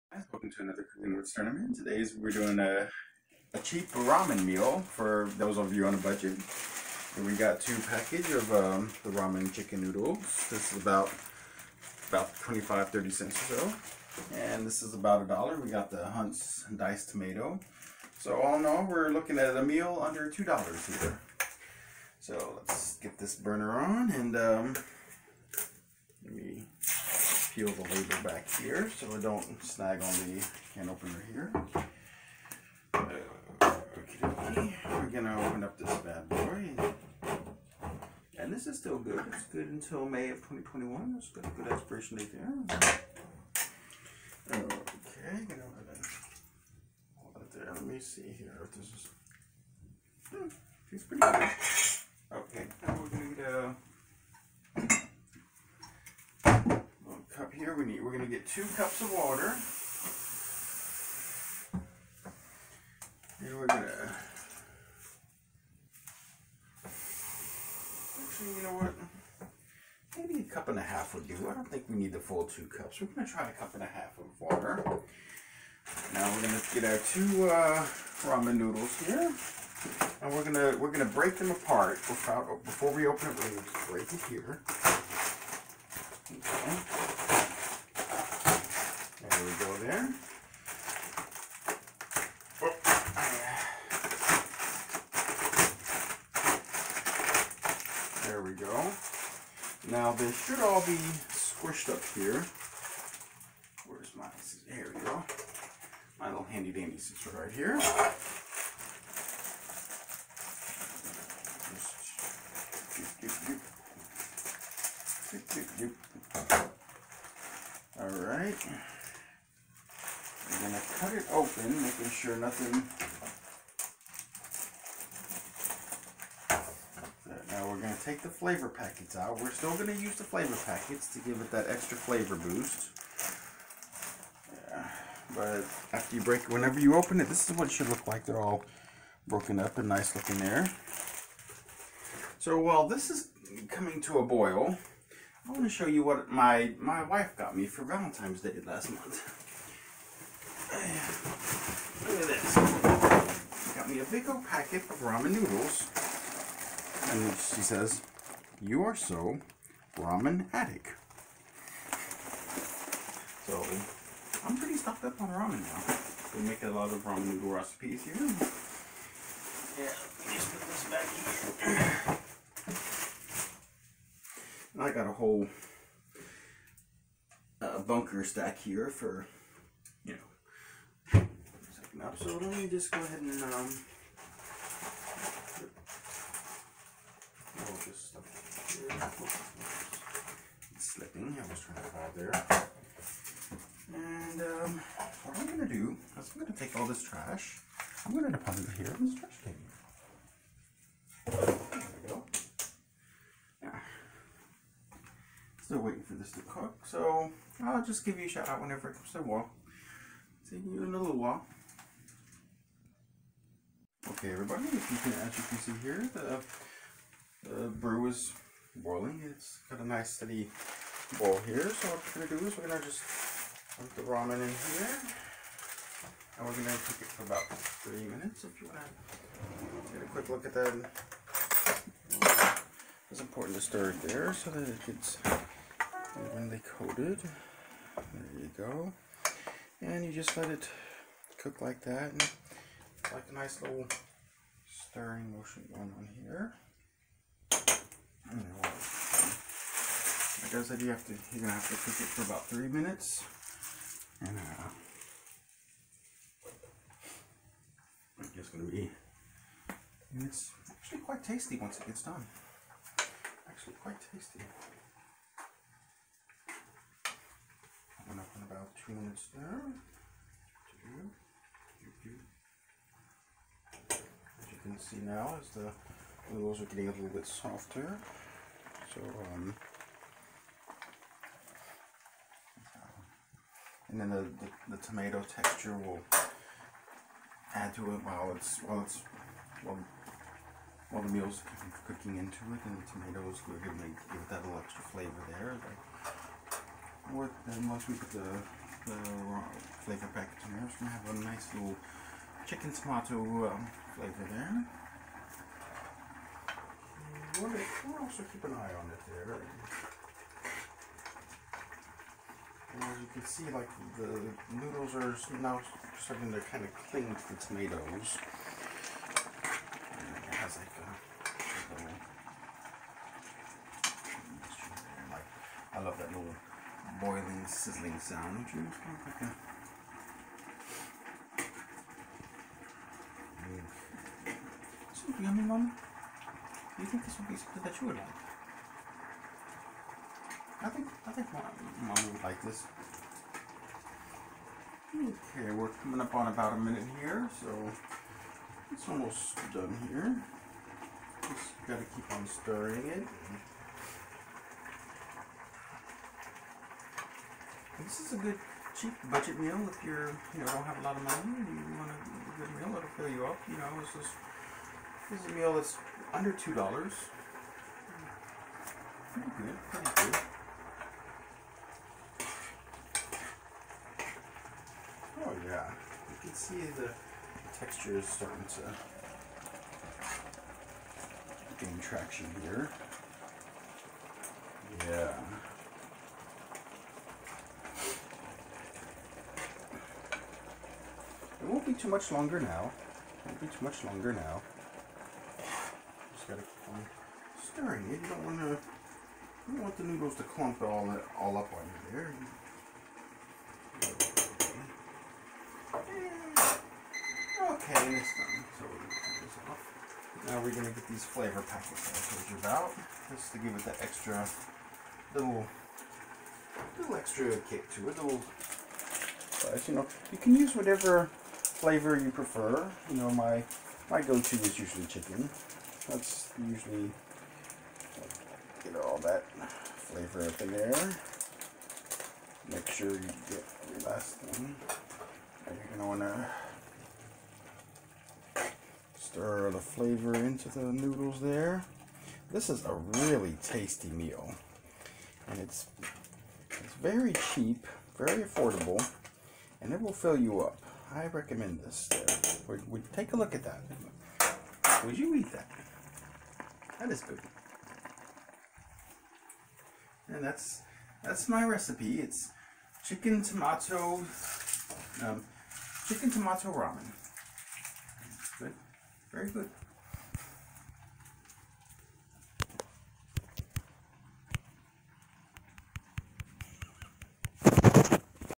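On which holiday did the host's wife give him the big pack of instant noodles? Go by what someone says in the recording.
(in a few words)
Valentine's Day.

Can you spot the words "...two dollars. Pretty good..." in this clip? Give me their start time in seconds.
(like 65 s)
366 s.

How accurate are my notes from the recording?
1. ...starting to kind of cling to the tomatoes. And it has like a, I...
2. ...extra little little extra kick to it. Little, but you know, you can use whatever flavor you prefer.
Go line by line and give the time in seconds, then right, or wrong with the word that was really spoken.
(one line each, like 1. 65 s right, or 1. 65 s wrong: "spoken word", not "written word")
1. 315 s right
2. 413 s right.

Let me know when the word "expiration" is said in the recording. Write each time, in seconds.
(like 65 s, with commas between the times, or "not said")
41 s.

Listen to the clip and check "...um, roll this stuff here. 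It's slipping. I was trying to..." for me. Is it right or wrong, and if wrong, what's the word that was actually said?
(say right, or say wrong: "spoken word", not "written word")
right.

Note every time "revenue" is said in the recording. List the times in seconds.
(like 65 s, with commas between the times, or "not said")
not said.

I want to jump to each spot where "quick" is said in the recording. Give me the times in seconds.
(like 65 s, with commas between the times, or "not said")
230 s.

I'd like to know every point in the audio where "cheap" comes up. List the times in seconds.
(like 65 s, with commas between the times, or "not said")
3 s, 358 s, 447 s.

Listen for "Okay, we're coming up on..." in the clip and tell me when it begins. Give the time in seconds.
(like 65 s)
344 s.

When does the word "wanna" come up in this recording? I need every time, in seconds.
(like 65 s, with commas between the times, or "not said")
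228 s, 435 s.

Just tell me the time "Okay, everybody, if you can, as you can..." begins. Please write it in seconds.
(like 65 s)
214 s.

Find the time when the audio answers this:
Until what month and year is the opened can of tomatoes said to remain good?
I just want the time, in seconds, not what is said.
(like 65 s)
40 s.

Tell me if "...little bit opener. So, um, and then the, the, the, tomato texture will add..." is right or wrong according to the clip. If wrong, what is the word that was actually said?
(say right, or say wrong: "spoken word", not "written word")
wrong: "softer", not "opener".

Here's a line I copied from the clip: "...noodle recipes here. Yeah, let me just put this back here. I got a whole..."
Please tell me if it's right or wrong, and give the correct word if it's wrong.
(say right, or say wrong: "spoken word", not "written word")
right.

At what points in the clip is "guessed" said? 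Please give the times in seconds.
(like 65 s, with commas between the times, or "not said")
not said.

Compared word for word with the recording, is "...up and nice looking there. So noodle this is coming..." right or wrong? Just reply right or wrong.
wrong.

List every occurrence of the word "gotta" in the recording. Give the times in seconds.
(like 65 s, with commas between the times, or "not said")
351 s, 396 s.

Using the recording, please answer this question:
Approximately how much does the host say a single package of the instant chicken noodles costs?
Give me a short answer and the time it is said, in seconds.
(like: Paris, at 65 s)
25-30 cents, at 12 s.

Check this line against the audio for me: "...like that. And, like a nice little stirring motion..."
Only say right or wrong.
right.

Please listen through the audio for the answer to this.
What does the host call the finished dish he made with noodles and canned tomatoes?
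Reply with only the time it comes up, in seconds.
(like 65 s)
465 s.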